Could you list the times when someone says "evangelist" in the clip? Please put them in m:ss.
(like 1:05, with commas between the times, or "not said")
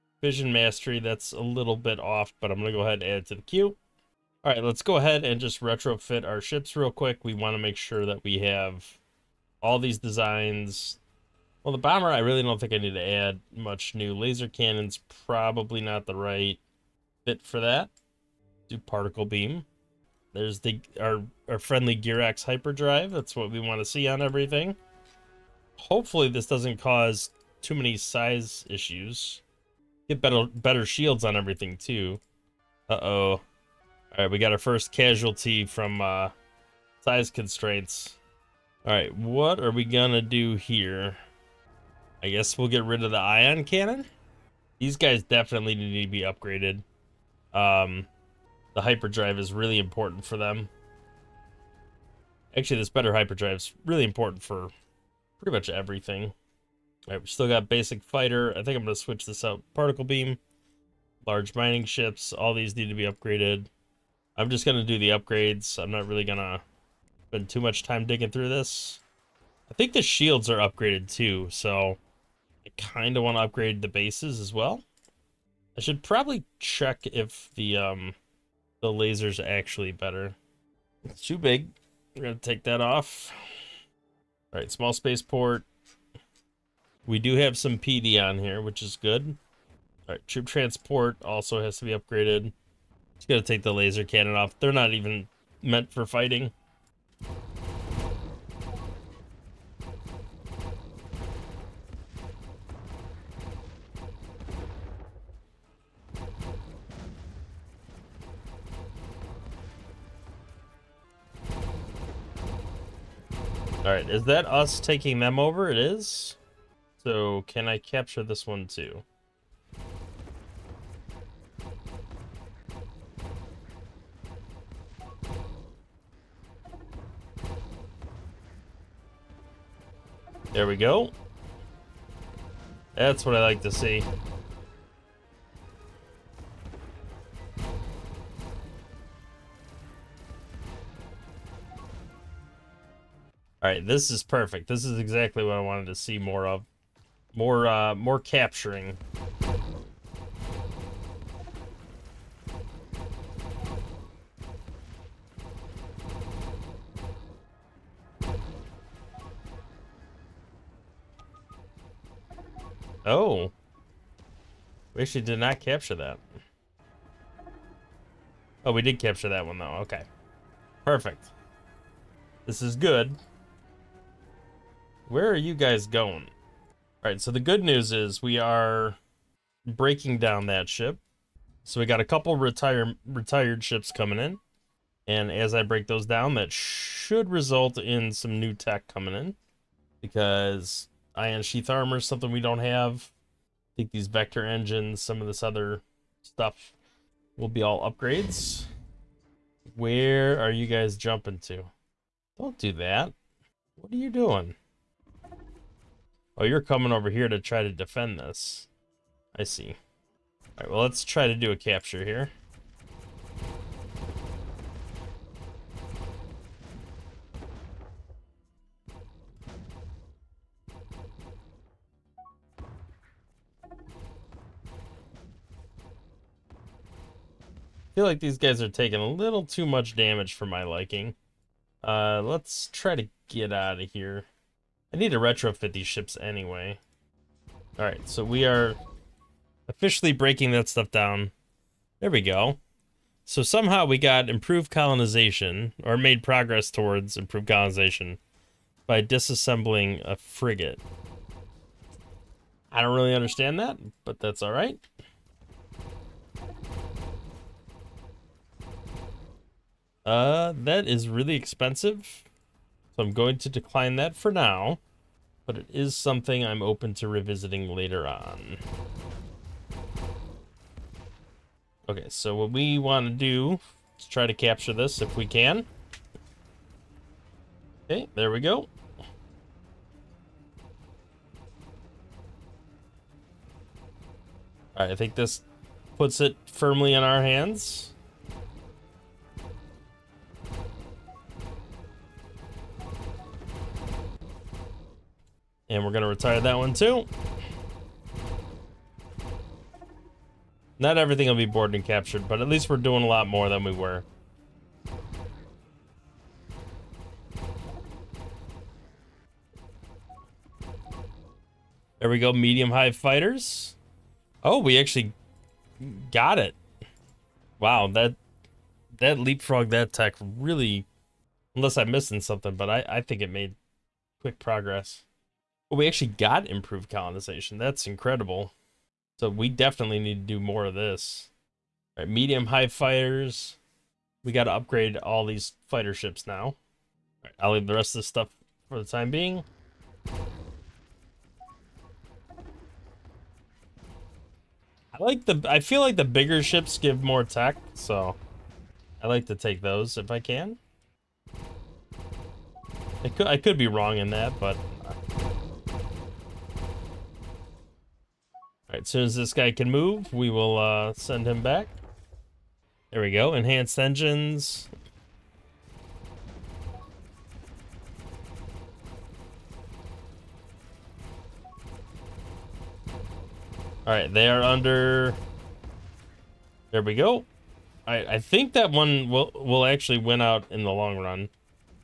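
not said.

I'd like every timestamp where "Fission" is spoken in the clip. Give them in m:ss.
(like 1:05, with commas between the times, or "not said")
0:00.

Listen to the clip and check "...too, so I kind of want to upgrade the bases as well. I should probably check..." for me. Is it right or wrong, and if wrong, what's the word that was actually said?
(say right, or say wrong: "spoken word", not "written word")
right.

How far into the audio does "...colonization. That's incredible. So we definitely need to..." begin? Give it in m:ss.
5:26.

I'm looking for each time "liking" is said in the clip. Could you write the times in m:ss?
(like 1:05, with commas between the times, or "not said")
3:50.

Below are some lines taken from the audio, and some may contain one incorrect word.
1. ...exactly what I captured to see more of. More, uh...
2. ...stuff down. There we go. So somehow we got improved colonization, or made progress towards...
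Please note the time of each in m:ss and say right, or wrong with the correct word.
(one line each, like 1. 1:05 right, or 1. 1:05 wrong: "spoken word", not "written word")
1. 2:25 wrong: "wanted", not "captured"
2. 4:00 right.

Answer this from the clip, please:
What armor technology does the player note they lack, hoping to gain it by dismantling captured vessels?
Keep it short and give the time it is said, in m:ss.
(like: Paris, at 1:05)
Ion sheath armor, at 3:11.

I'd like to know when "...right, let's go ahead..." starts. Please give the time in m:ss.
0:04.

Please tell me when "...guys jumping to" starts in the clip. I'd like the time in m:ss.
3:20.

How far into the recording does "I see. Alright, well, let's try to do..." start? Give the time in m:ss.
3:29.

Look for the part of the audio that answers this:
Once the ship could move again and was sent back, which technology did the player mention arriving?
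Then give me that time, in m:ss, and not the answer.
6:03.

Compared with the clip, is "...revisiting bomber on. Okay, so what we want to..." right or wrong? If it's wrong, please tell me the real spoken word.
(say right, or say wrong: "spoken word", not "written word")
wrong: "later", not "bomber".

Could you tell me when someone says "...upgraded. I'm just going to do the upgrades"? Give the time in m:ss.
1:03.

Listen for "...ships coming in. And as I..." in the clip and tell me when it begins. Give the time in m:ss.
3:03.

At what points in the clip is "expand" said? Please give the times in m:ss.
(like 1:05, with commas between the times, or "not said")
not said.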